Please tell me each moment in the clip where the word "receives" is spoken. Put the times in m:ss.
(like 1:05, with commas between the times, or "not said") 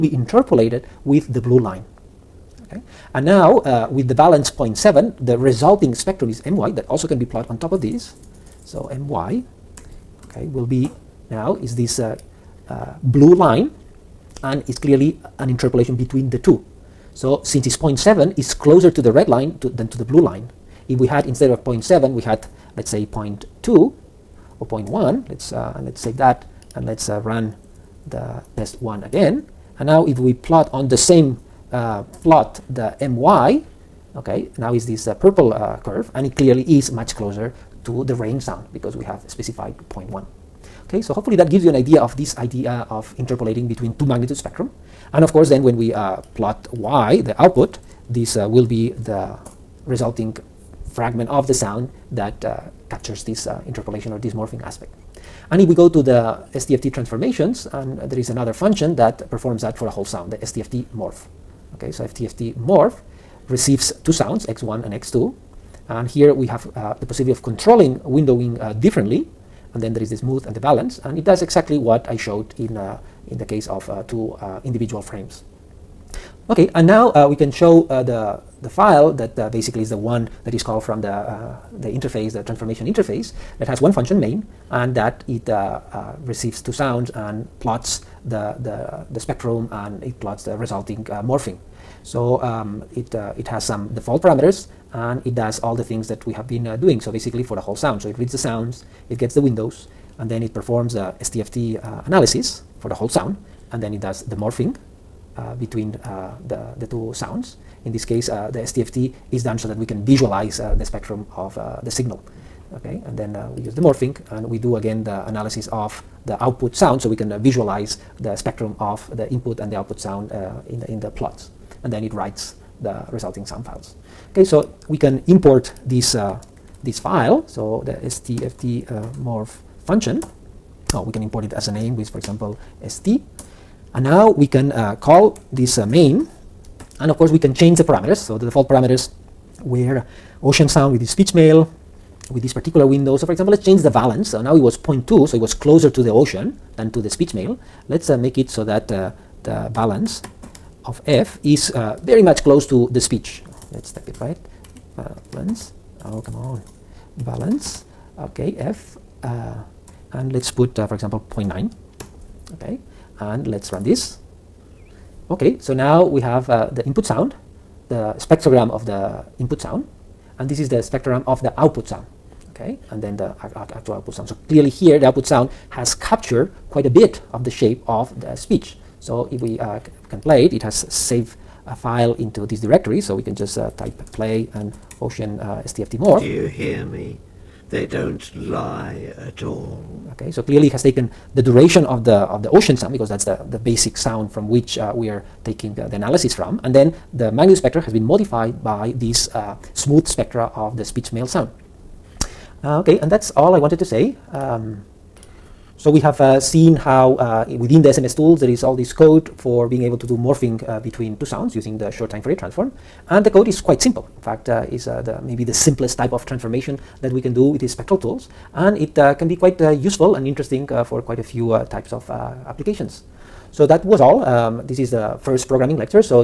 1:03, 1:26.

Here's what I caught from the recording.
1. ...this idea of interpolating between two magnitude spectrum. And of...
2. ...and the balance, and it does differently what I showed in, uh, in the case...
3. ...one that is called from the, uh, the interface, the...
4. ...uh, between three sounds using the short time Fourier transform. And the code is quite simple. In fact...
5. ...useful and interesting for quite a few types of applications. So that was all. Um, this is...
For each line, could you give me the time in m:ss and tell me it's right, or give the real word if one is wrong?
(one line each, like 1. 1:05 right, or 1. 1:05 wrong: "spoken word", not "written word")
1. 0:42 right
2. 1:10 wrong: "exactly", not "differently"
3. 1:19 right
4. 3:30 wrong: "two", not "three"
5. 3:39 right.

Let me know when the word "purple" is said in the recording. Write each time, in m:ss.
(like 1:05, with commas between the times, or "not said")
0:35.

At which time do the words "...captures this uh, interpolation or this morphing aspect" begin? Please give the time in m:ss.
0:52.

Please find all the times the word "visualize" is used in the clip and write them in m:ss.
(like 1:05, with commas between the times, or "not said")
1:50, 1:57.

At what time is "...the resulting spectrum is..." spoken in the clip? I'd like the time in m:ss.
0:05.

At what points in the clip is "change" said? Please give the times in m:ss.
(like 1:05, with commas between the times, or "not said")
2:17, 2:23.